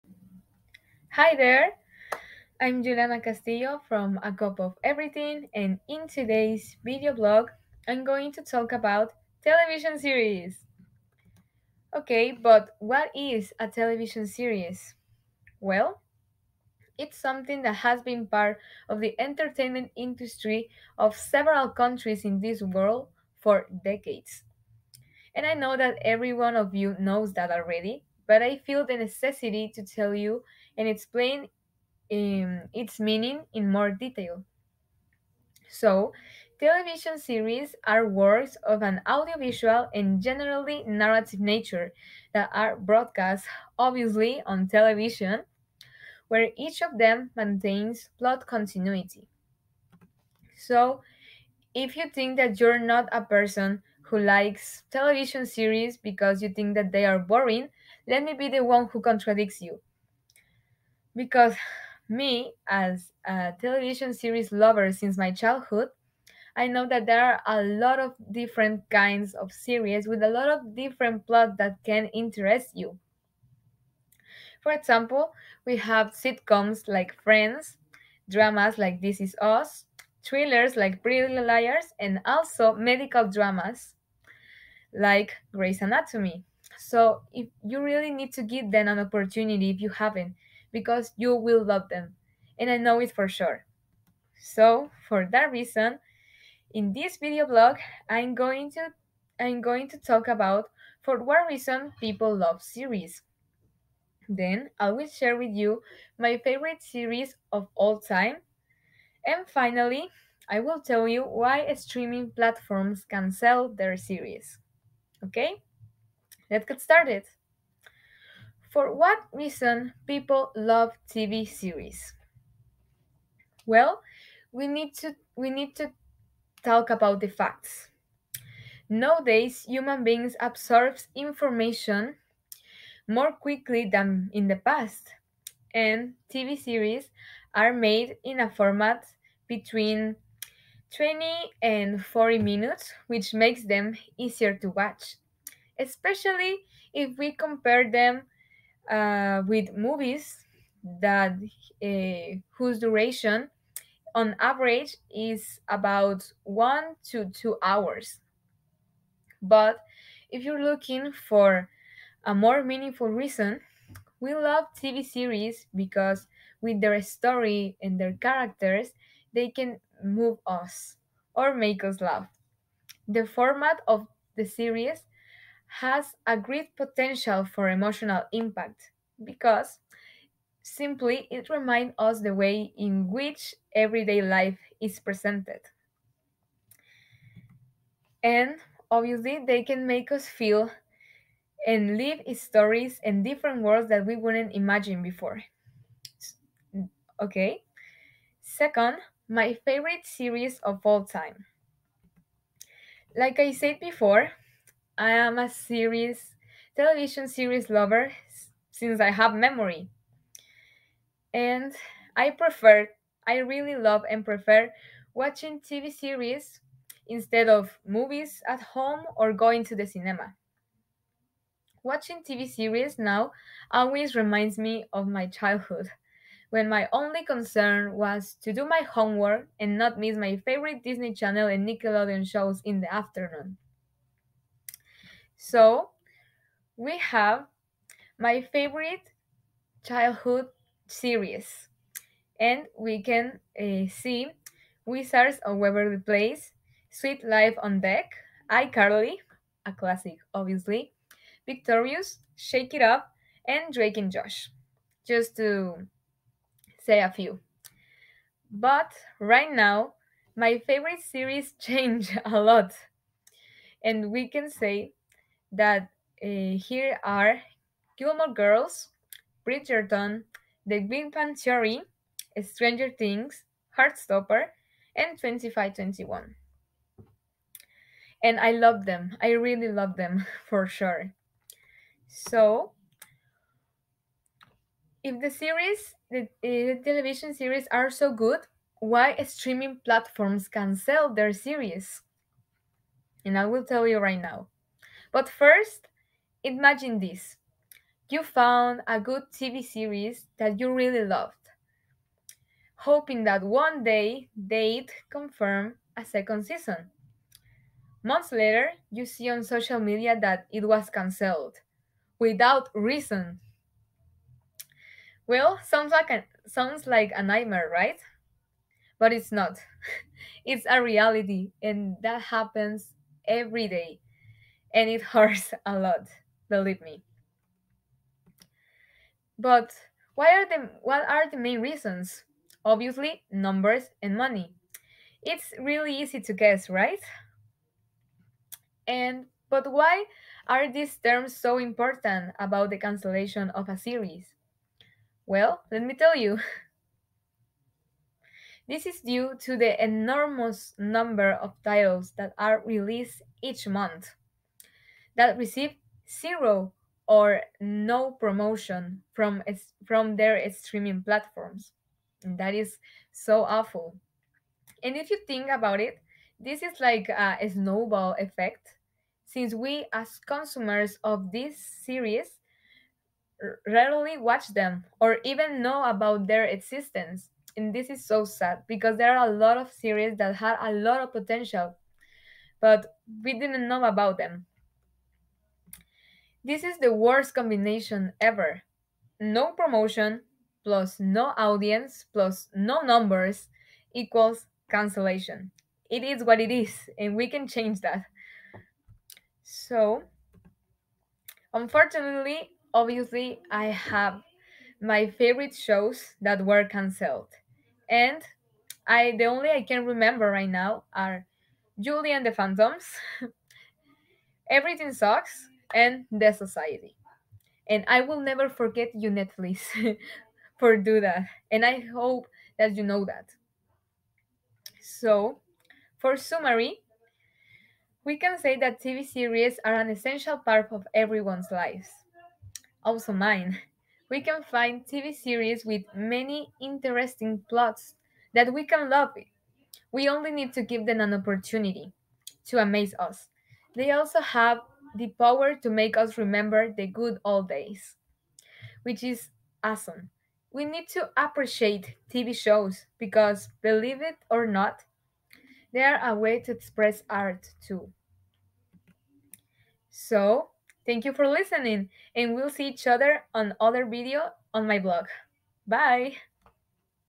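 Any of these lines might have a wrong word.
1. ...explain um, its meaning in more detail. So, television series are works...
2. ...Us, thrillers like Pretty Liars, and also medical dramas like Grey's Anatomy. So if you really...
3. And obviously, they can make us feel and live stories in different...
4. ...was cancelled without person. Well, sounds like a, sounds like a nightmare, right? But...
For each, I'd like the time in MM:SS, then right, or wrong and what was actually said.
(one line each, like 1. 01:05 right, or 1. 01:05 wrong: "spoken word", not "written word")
1. 00:30 right
2. 01:19 right
3. 03:08 right
4. 05:10 wrong: "reason", not "person".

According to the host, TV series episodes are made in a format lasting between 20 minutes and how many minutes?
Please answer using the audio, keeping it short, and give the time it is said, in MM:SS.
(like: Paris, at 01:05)
40 minutes, at 02:22.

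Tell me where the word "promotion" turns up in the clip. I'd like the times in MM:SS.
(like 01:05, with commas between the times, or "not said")
05:58, 06:29.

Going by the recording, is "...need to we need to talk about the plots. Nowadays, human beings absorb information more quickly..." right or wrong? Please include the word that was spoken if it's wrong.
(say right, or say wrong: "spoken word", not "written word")
wrong: "facts", not "plots".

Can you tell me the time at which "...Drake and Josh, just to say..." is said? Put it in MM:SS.
04:13.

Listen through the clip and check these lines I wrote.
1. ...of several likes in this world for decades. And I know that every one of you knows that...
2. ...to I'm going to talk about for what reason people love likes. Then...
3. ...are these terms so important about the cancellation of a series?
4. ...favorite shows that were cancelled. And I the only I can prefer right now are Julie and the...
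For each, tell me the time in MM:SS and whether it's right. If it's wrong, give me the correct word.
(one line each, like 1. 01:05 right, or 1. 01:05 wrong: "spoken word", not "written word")
1. 00:20 wrong: "countries", not "likes"
2. 01:38 wrong: "series", not "likes"
3. 05:40 right
4. 06:45 wrong: "remember", not "prefer".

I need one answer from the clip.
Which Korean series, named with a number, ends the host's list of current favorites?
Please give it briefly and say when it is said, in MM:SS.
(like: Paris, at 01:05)
2521, at 04:35.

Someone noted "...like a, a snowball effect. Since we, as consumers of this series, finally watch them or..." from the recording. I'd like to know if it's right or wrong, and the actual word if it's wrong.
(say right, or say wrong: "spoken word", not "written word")
wrong: "rarely", not "finally".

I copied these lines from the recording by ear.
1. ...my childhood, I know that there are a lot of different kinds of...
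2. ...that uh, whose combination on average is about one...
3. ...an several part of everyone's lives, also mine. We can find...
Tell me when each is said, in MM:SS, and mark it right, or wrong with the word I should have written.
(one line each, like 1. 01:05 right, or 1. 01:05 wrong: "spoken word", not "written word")
1. 01:05 right
2. 02:31 wrong: "duration", not "combination"
3. 07:09 wrong: "essential", not "several".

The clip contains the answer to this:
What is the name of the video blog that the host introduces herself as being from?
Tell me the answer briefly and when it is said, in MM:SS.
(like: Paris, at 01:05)
A Cup of Everything, at 00:04.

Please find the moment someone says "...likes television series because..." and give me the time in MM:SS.
00:54.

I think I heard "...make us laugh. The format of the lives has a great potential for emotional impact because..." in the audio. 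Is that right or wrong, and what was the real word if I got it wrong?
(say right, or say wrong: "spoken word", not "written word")
wrong: "series", not "lives".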